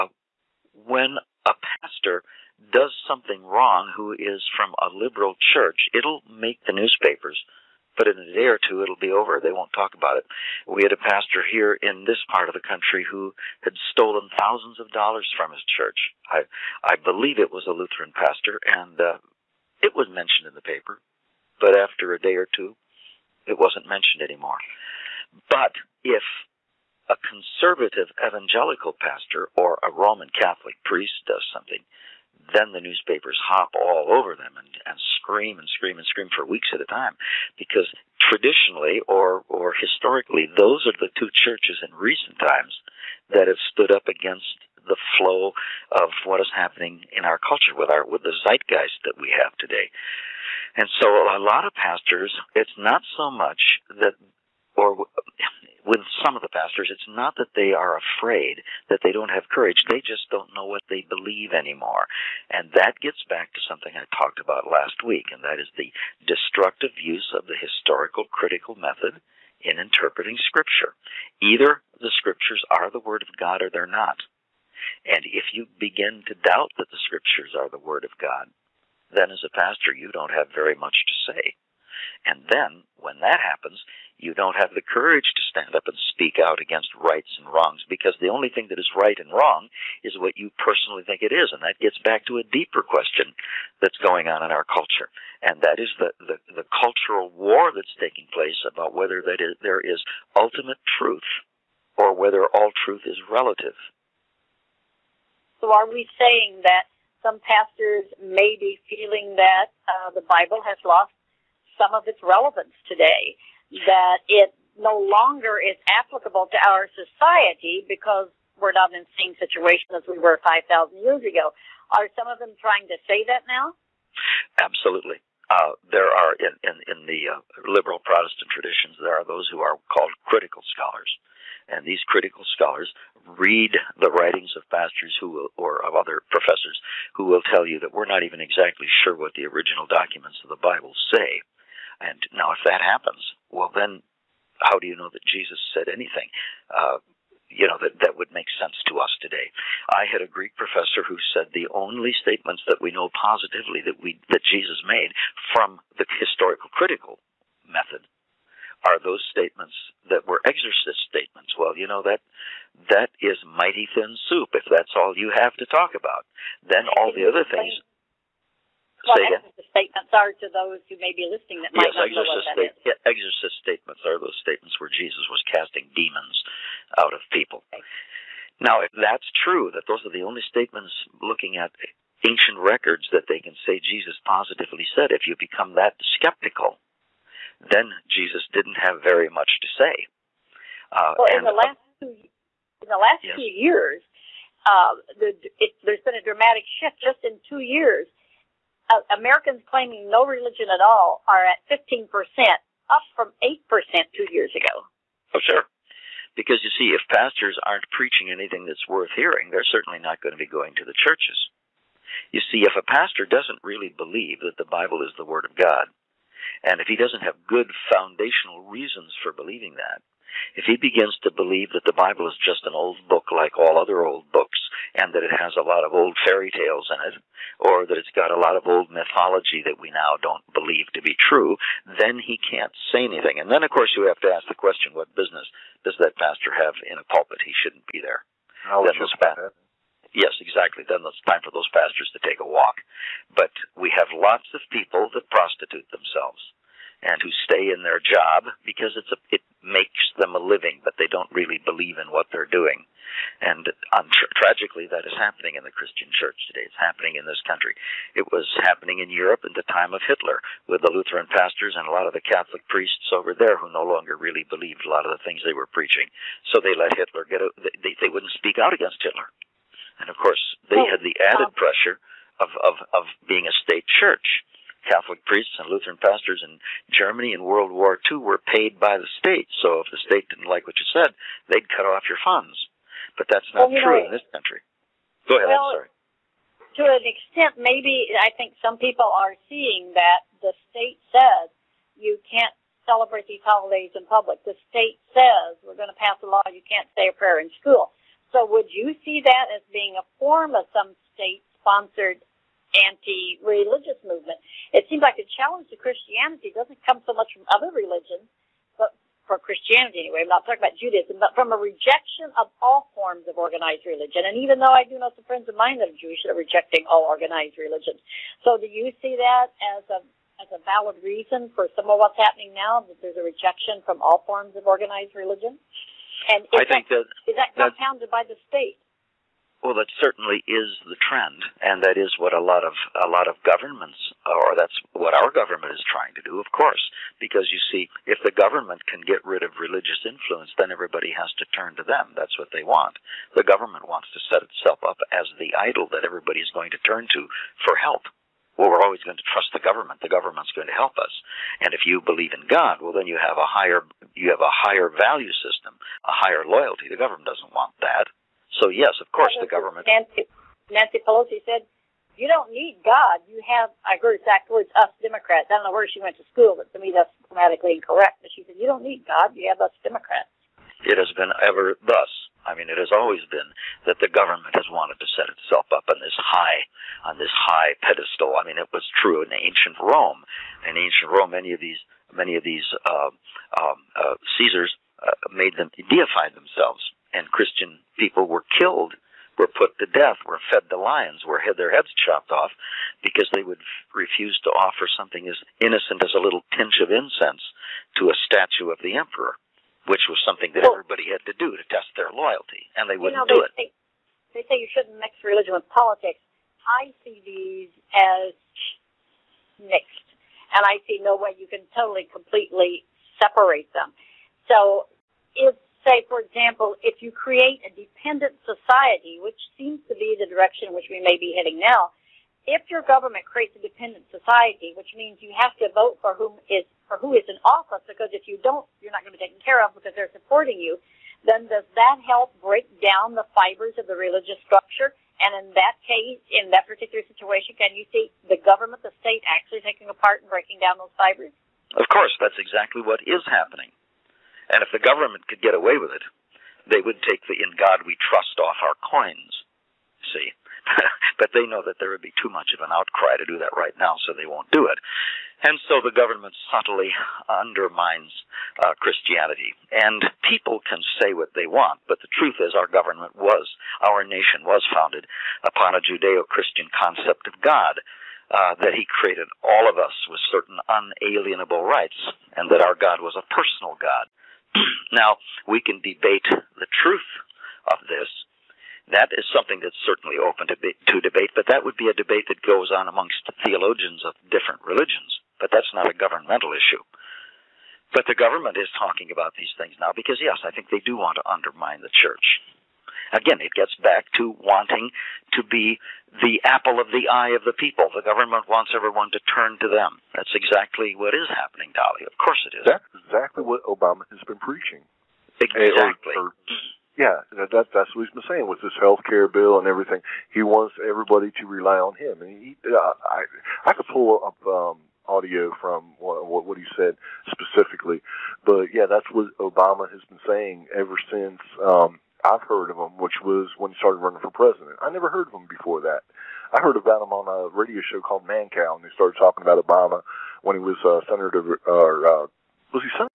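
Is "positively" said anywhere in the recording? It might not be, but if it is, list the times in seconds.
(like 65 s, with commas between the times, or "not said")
153 s, 184 s.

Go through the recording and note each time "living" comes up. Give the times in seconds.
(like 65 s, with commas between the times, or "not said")
250 s.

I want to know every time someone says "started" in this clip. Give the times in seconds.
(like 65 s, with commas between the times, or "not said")
523 s, 528 s.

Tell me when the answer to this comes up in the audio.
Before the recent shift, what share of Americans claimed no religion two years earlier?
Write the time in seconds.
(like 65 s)
203 s.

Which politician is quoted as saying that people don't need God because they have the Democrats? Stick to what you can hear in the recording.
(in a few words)
Nancy Pelosi.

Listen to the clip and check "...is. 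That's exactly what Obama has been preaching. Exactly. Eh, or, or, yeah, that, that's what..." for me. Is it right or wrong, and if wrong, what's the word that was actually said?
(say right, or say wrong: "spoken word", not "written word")
right.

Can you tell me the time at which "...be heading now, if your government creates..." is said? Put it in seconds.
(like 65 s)
421 s.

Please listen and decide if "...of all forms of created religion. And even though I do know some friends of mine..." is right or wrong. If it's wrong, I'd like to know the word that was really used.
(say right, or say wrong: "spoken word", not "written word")
wrong: "organized", not "created".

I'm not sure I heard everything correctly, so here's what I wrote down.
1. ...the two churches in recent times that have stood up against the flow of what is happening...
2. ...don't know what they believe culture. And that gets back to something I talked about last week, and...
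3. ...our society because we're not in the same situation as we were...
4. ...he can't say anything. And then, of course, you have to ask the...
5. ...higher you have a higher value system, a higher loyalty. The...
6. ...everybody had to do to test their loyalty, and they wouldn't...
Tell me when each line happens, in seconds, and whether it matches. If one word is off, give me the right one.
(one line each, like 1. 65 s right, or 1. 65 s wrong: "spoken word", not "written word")
1. 41 s right
2. 60 s wrong: "anymore", not "culture"
3. 116 s right
4. 232 s right
5. 353 s right
6. 400 s right.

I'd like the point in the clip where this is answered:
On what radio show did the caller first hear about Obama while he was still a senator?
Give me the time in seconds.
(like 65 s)
528 s.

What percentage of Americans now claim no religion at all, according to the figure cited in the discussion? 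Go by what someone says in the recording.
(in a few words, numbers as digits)
15%.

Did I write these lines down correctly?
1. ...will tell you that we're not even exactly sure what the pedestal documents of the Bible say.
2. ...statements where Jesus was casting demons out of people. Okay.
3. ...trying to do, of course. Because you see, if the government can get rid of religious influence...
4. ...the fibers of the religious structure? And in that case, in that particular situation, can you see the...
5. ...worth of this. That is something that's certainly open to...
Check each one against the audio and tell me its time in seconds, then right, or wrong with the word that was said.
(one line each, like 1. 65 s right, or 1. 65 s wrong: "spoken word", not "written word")
1. 137 s wrong: "original", not "pedestal"
2. 174 s right
3. 335 s right
4. 433 s right
5. 476 s wrong: "truth", not "worth".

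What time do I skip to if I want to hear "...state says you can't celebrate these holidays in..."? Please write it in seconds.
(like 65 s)
290 s.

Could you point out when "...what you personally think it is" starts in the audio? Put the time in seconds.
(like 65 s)
90 s.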